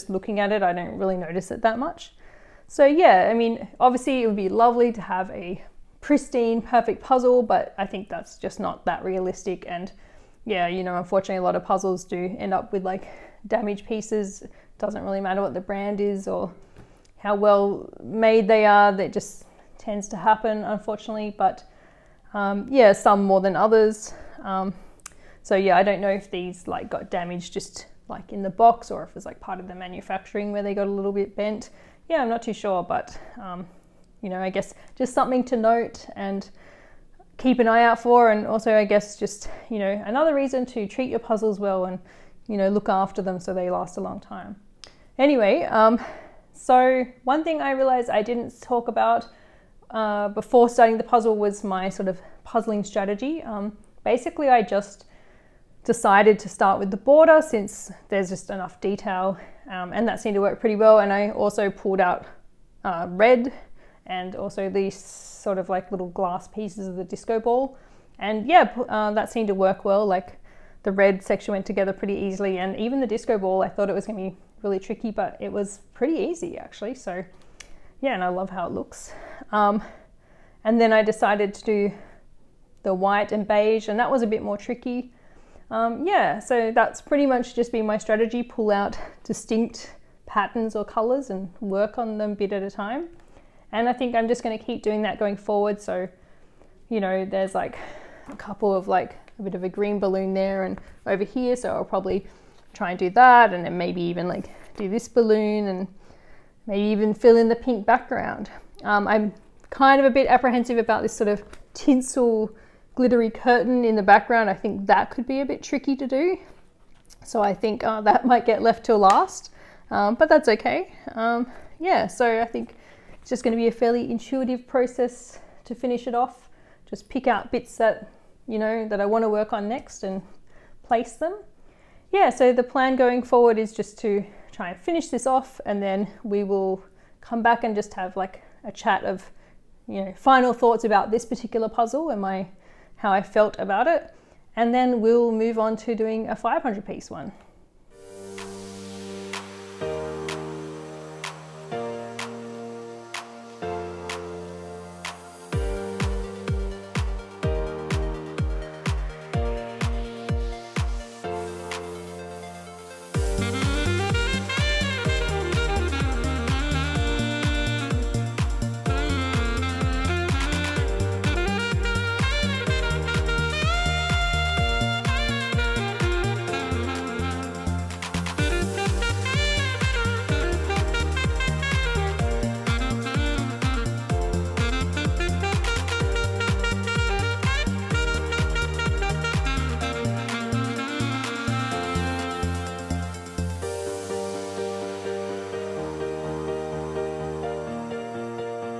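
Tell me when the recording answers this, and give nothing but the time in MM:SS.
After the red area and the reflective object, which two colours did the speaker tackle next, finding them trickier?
01:22.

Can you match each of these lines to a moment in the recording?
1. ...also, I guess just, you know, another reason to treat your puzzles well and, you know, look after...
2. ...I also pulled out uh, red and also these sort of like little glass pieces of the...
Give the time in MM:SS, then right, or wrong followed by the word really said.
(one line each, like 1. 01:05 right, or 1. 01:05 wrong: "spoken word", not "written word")
1. 00:38 right
2. 01:01 right.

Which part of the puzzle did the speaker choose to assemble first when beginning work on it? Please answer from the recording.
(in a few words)
The border.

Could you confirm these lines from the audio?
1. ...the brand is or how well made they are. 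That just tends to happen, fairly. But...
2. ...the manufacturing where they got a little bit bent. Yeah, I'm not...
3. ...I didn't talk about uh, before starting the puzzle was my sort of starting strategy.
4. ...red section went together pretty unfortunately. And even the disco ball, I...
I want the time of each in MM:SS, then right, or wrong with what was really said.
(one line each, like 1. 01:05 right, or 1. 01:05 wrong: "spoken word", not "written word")
1. 00:15 wrong: "unfortunately", not "fairly"
2. 00:29 right
3. 00:48 wrong: "puzzling", not "starting"
4. 01:10 wrong: "easily", not "unfortunately".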